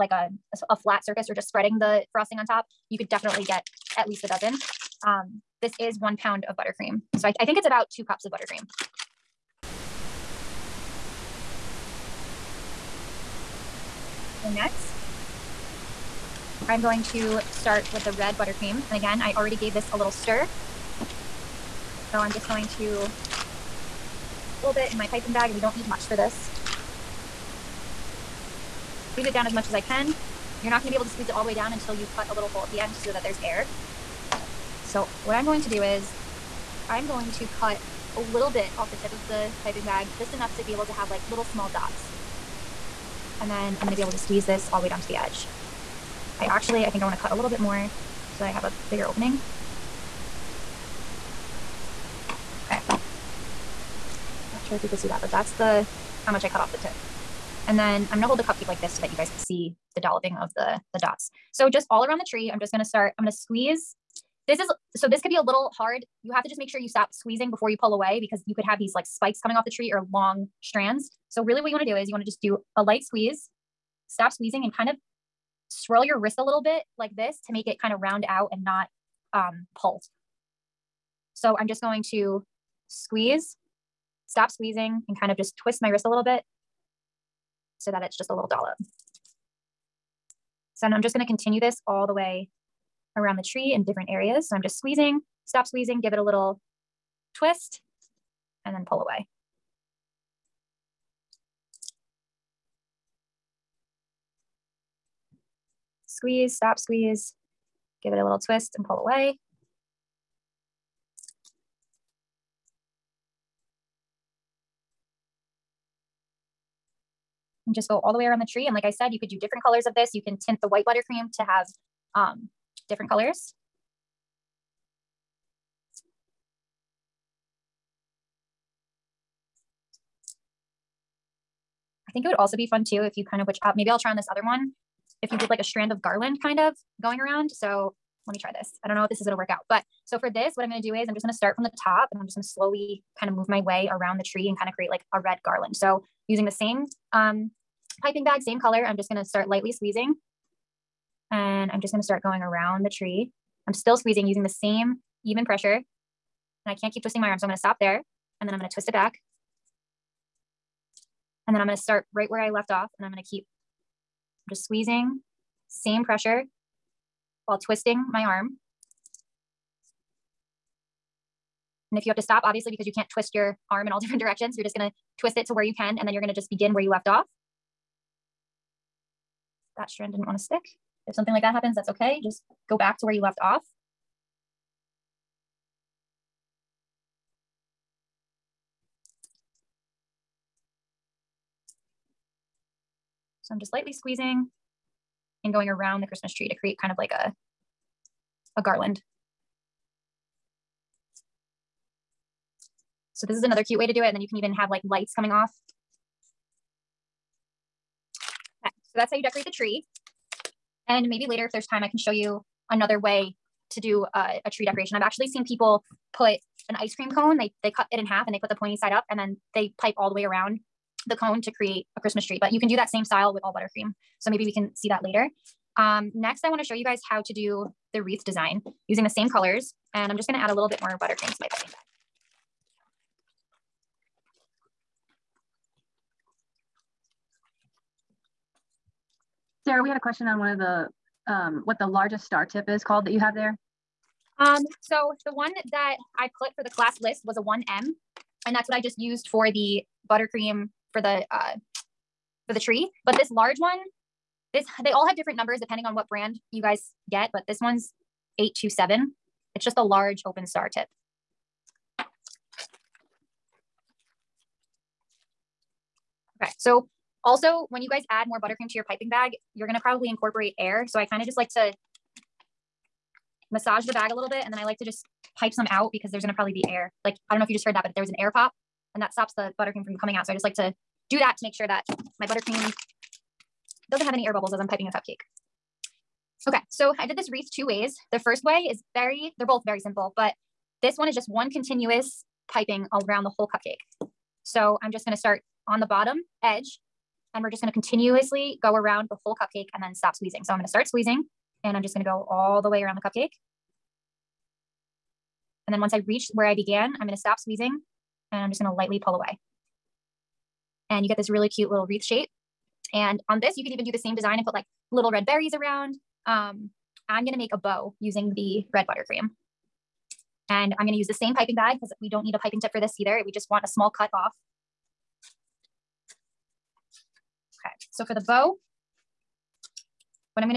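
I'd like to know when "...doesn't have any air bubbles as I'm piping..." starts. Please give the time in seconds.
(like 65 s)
283 s.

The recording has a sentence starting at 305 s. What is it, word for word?
And then once I reach where I began, I'm going to stop squeezing and I'm just going to lightly pull away.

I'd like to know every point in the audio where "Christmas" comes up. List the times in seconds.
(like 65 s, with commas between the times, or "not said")
196 s, 221 s.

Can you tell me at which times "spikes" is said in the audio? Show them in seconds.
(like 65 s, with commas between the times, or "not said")
69 s.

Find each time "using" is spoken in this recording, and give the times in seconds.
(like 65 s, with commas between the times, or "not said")
146 s, 154 s, 228 s, 318 s.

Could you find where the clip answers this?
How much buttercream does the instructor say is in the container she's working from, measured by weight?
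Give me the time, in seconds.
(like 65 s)
5 s.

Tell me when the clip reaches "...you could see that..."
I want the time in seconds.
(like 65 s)
54 s.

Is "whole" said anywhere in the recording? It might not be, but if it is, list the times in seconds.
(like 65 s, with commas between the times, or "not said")
293 s, 299 s.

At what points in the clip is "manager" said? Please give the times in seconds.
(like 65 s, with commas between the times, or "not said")
not said.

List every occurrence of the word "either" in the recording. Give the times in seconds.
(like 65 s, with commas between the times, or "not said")
322 s.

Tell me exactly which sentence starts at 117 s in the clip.
just go all the way around the tree.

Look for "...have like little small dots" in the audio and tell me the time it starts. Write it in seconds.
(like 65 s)
40 s.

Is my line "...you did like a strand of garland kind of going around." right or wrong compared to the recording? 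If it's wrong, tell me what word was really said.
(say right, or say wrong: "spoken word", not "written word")
right.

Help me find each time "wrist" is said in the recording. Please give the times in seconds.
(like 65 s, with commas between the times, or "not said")
76 s, 85 s.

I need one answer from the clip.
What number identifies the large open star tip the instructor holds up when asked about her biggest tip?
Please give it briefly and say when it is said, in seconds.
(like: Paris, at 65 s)
827, at 258 s.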